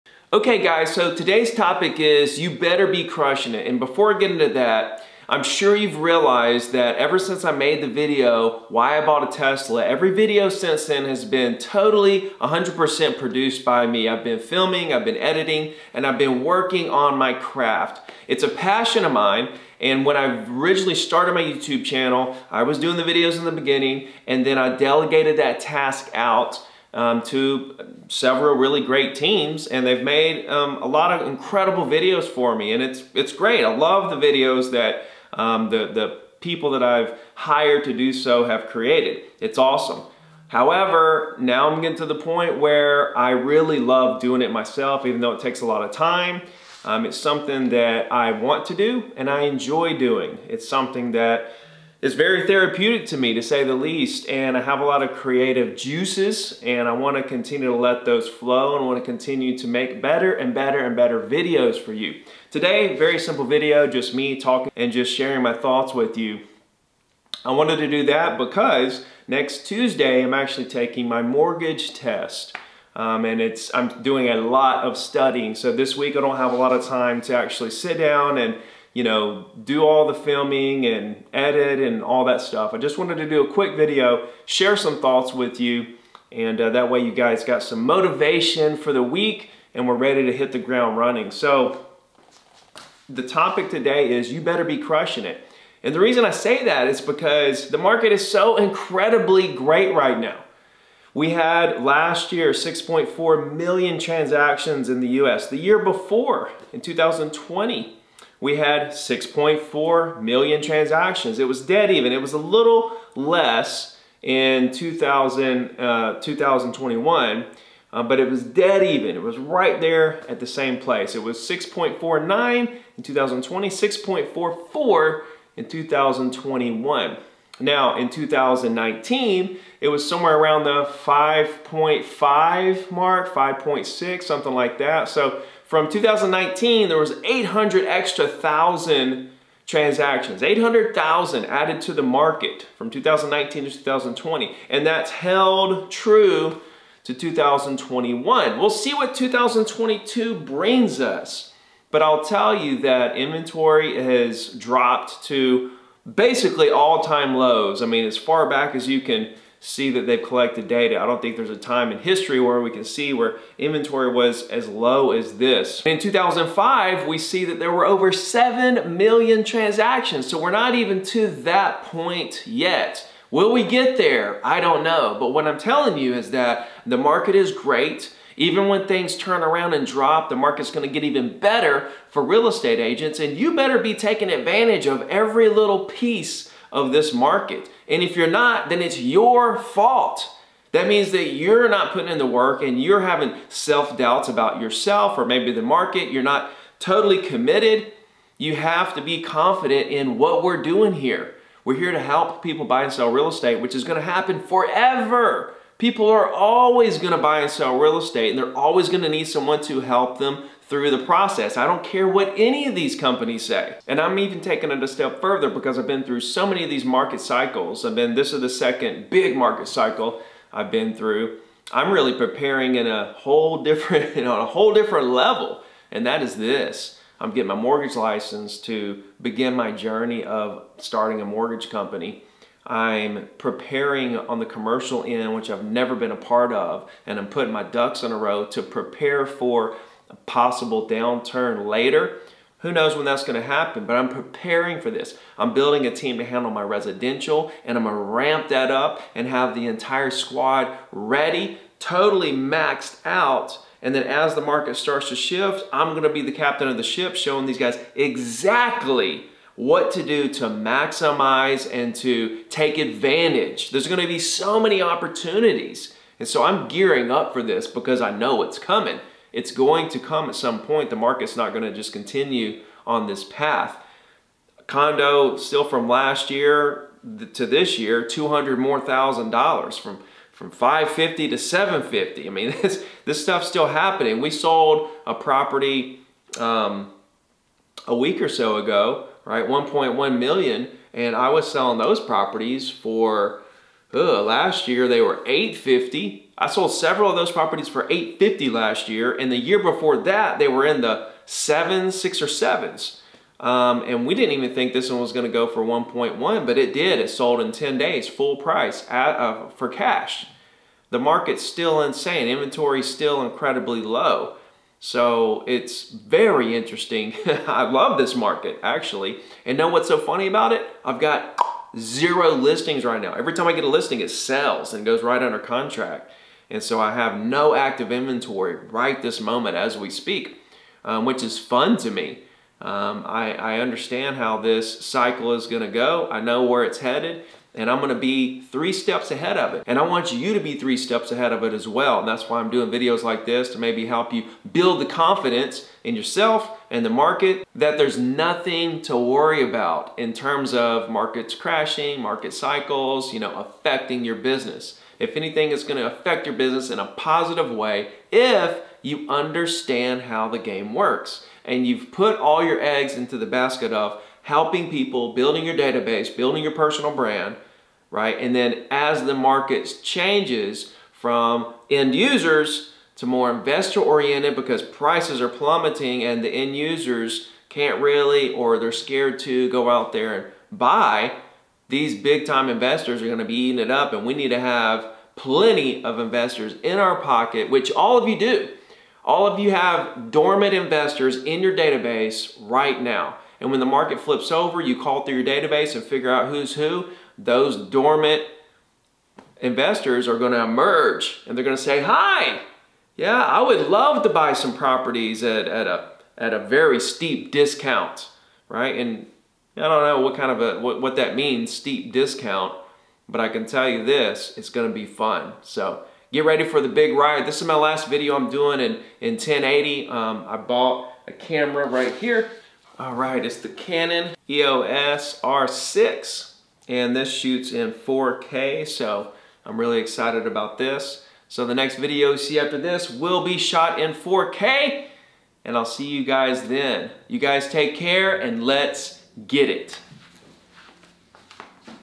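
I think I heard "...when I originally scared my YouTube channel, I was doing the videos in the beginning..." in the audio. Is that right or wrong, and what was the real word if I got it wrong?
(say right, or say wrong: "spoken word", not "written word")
wrong: "started", not "scared".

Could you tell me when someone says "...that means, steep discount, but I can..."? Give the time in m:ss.
6:50.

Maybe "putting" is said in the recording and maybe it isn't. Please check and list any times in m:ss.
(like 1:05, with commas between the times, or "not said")
3:11, 3:57.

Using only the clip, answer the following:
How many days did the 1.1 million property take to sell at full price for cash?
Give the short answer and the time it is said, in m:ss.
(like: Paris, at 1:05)
10 days, at 5:07.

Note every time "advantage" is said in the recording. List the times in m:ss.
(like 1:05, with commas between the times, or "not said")
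3:04, 4:22.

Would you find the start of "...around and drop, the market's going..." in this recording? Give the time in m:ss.
2:59.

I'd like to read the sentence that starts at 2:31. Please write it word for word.
But I'll tell you that inventory has dropped to basically all-time lows.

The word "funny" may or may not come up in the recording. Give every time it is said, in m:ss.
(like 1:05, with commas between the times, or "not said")
5:19.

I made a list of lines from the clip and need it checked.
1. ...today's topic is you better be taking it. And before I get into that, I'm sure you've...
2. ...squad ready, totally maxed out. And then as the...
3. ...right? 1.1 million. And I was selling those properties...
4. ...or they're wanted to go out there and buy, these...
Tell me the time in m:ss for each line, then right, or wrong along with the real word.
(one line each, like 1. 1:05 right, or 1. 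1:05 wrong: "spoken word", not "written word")
1. 0:01 wrong: "crushing", not "taking"
2. 4:10 right
3. 4:49 right
4. 6:18 wrong: "scared", not "wanted".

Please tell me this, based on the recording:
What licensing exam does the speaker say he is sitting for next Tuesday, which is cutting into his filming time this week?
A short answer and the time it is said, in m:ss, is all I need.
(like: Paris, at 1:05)
Mortgage test, at 1:11.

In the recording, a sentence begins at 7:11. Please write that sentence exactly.
So the next video you see after this will be shot in 4K, and I'll see you guys then.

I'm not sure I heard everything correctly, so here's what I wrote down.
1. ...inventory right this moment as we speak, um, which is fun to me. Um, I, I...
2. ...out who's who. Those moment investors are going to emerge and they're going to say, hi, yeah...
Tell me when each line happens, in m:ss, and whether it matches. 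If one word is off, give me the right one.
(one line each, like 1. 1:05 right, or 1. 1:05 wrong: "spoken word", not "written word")
1. 5:27 right
2. 6:36 wrong: "dormant", not "moment".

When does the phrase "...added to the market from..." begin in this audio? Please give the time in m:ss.
2:21.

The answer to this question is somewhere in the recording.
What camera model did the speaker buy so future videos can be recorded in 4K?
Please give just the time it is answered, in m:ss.
7:03.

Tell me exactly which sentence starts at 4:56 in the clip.
I sold several of those properties for 850 last year.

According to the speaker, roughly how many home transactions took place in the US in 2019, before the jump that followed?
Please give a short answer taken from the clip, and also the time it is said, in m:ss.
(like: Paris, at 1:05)
5.5 million, at 2:11.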